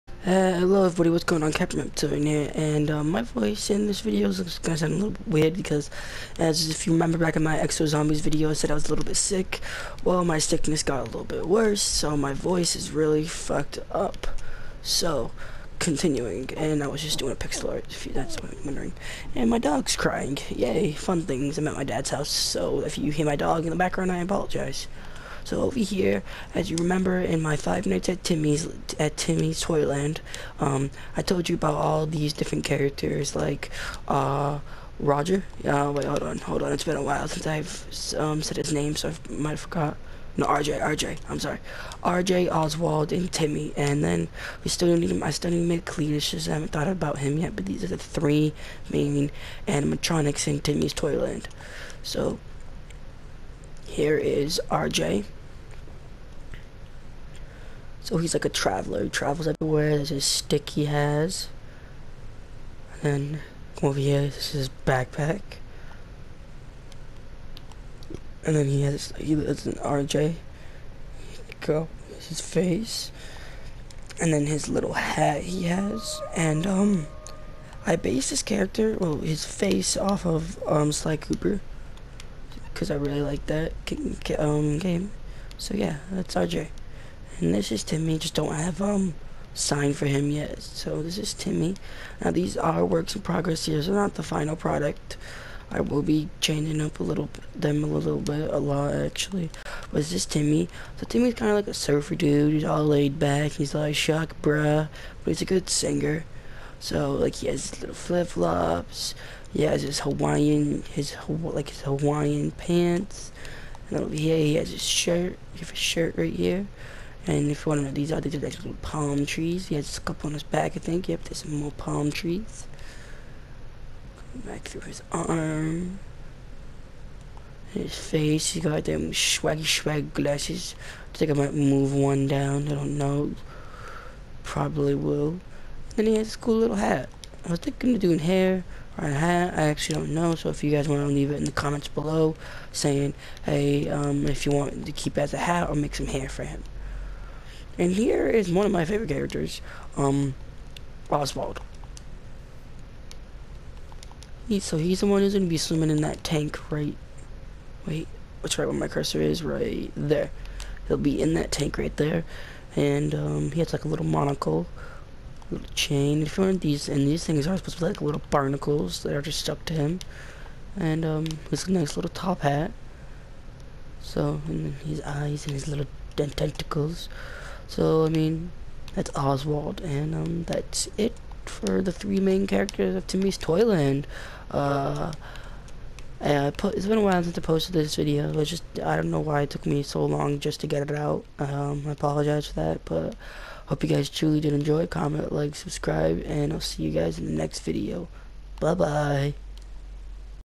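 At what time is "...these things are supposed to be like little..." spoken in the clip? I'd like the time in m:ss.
2:47.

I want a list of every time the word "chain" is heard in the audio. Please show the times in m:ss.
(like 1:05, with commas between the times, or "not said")
2:45.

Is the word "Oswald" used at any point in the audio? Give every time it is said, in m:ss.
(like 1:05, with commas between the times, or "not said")
0:42, 2:31, 2:59.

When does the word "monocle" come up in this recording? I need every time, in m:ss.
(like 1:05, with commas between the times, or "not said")
2:44.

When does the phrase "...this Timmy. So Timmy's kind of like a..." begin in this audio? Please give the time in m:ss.
1:40.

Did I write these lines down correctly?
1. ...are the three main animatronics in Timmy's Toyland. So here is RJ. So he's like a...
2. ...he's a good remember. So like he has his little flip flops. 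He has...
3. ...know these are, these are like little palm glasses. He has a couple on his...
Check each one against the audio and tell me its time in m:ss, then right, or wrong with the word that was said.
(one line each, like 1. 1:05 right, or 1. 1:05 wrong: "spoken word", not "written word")
1. 0:47 right
2. 1:45 wrong: "singer", not "remember"
3. 1:57 wrong: "trees", not "glasses".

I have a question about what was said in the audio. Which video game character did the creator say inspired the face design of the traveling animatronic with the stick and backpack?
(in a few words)
Sly Cooper.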